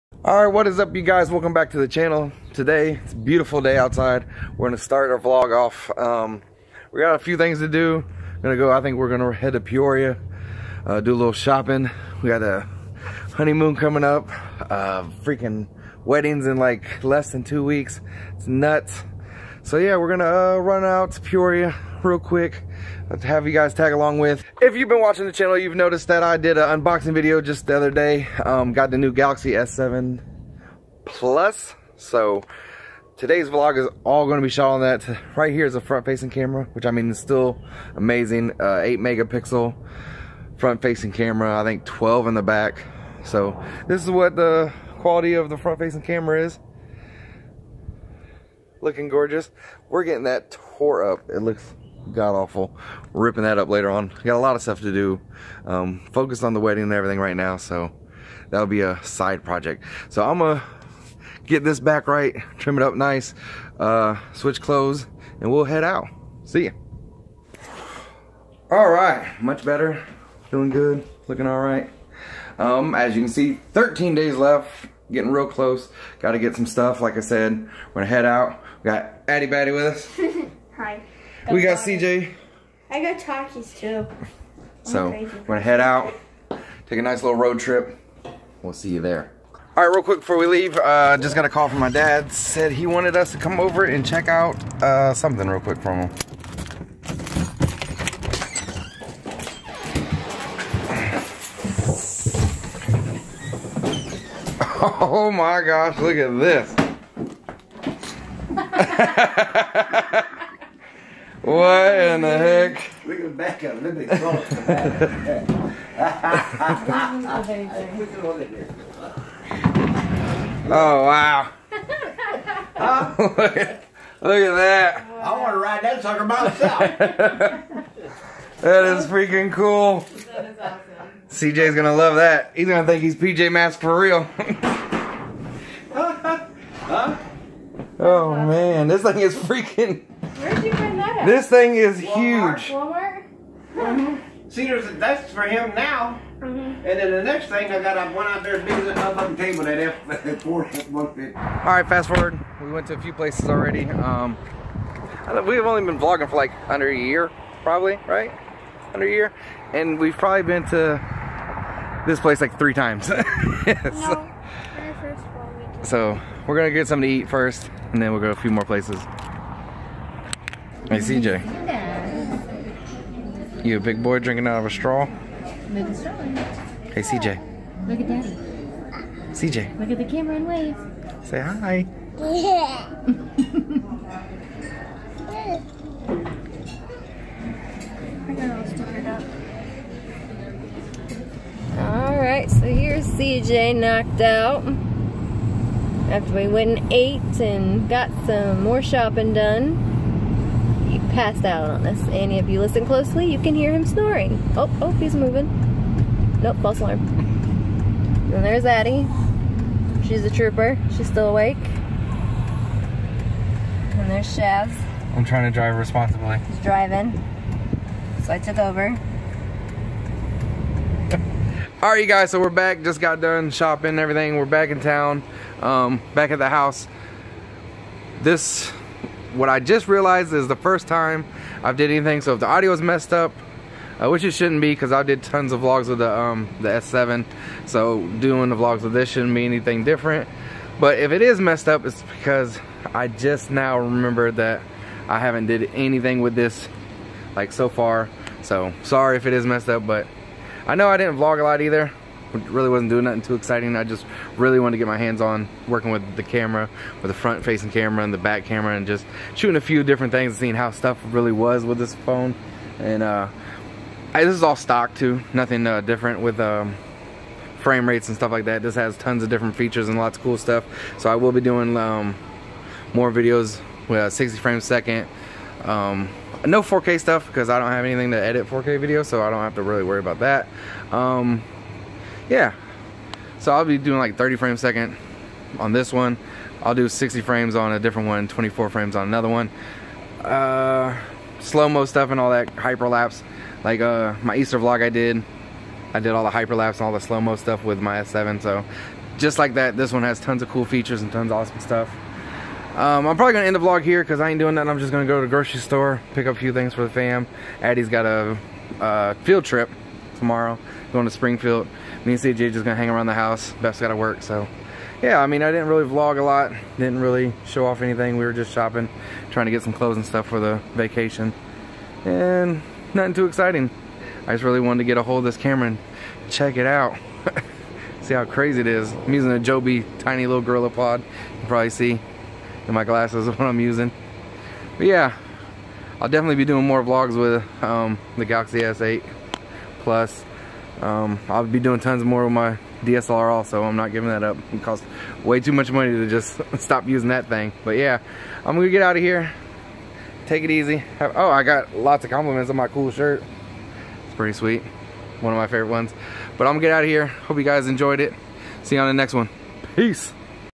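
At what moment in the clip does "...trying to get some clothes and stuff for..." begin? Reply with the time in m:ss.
5:19.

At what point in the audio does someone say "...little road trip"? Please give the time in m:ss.
1:27.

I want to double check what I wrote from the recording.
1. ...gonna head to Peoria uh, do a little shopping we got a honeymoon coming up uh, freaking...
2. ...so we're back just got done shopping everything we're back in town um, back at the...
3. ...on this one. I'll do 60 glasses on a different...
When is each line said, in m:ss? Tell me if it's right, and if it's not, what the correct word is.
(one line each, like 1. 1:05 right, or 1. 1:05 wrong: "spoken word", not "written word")
1. 0:09 right
2. 3:42 right
3. 4:45 wrong: "frames", not "glasses".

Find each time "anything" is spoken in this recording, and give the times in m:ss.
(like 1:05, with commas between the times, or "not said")
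3:51, 3:59, 4:05, 4:37, 5:17.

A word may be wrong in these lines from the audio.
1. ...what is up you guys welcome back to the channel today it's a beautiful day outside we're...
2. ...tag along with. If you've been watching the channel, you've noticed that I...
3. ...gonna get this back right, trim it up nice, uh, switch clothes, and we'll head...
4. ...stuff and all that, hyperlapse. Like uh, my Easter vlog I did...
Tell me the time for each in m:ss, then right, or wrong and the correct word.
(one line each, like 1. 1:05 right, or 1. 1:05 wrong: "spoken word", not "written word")
1. 0:00 right
2. 0:23 right
3. 1:00 right
4. 4:51 right.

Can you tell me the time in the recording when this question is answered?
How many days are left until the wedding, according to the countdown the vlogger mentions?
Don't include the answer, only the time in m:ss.
1:13.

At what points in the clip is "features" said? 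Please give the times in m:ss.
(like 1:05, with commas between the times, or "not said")
4:29, 5:00.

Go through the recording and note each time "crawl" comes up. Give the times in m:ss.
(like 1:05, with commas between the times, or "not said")
1:54.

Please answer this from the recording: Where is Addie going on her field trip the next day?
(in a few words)
Springfield.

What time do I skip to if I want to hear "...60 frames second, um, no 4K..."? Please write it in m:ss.
4:34.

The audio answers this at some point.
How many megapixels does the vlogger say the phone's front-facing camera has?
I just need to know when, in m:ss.
0:38.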